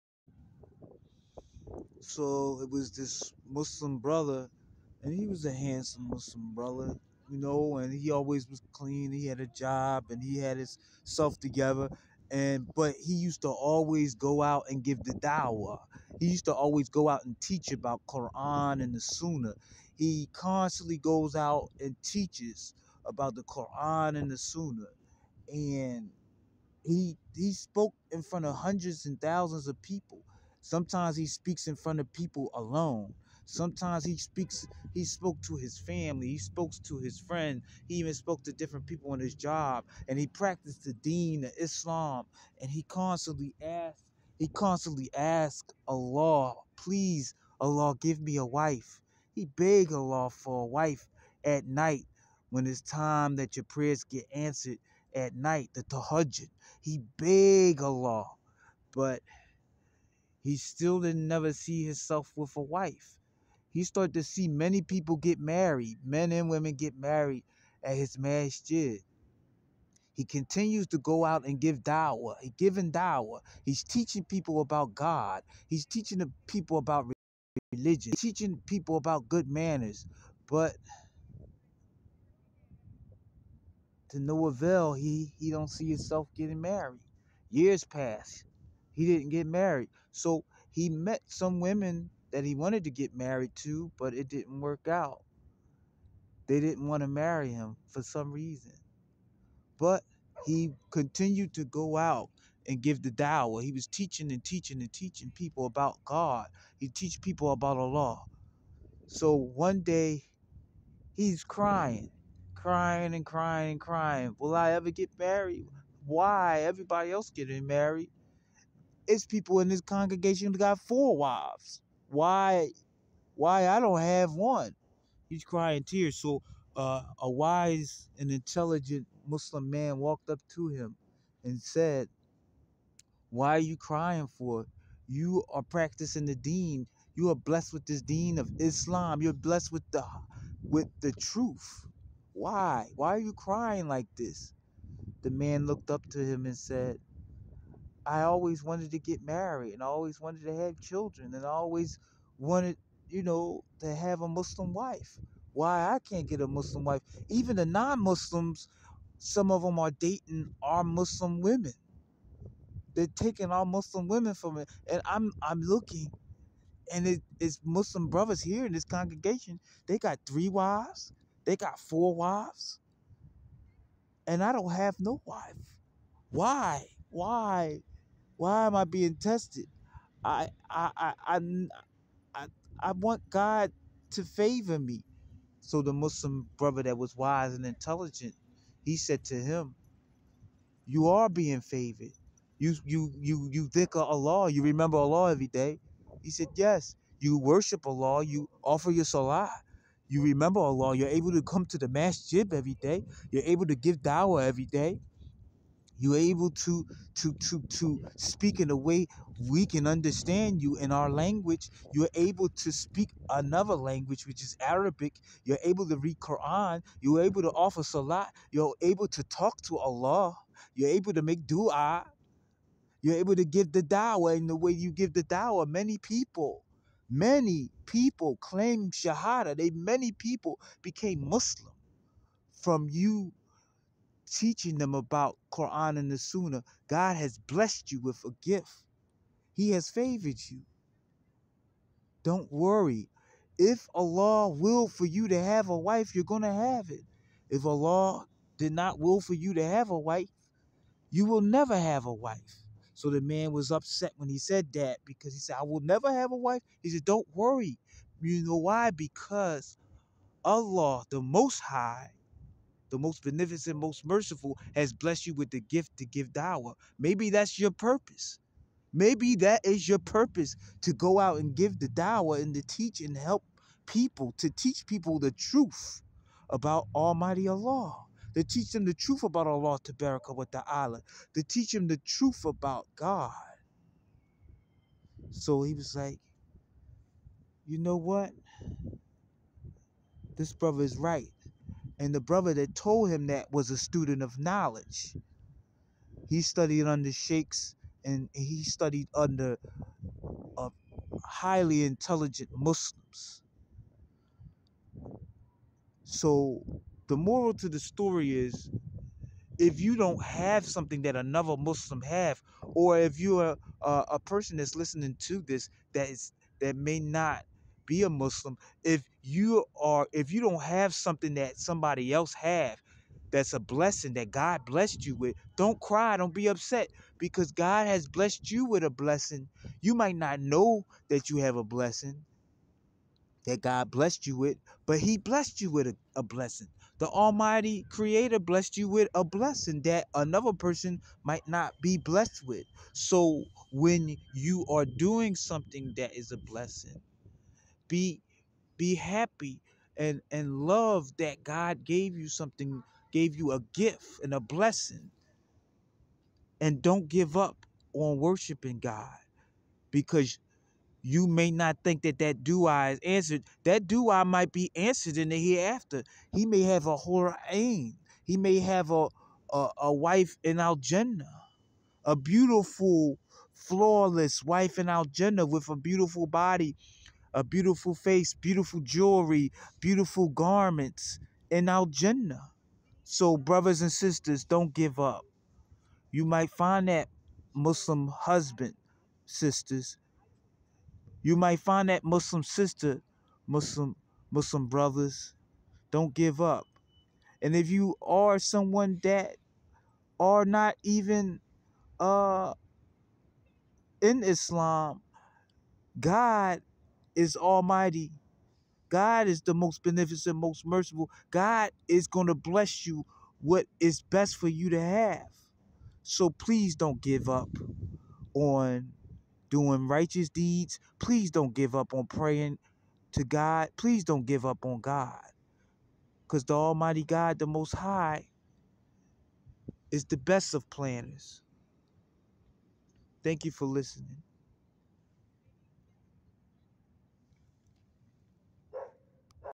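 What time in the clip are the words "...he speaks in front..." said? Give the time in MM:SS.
00:31.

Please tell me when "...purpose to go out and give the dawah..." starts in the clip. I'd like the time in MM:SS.
04:29.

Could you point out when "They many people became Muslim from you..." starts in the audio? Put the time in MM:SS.
03:49.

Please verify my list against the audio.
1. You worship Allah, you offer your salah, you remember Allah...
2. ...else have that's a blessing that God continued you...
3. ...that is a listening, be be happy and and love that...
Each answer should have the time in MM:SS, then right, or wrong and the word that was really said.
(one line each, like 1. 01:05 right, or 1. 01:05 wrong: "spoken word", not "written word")
1. 03:17 right
2. 05:22 wrong: "blessed", not "continued"
3. 05:45 wrong: "blessing", not "listening".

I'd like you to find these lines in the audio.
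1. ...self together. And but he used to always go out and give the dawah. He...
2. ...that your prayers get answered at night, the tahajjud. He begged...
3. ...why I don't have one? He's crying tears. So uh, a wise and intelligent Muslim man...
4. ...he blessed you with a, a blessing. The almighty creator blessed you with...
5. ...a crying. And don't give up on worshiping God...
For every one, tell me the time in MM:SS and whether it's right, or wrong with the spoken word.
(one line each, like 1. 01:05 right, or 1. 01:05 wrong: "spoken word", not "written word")
1. 00:11 right
2. 00:53 right
3. 02:03 right
4. 05:34 right
5. 05:54 wrong: "blessing", not "crying".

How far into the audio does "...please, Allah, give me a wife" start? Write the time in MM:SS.
00:46.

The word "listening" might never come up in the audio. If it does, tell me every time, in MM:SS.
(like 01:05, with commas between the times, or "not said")
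05:14, 07:13.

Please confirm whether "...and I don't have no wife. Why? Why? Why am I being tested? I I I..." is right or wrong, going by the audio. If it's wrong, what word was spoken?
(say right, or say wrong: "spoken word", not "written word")
right.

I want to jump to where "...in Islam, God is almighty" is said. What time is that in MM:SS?
06:44.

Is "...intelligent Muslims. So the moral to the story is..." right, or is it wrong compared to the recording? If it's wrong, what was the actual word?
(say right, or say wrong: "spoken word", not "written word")
right.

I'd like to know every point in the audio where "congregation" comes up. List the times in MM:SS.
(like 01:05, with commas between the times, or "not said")
01:59, 02:48.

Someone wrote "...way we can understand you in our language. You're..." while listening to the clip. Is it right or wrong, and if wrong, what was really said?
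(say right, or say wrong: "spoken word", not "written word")
right.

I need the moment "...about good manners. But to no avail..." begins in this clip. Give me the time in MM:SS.
01:18.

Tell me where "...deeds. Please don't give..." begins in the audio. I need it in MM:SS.
07:00.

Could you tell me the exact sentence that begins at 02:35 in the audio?
Why I can't get a Muslim wife?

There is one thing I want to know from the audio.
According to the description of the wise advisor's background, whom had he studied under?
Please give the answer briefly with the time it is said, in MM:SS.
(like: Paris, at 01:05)
Sheikhs, at 04:57.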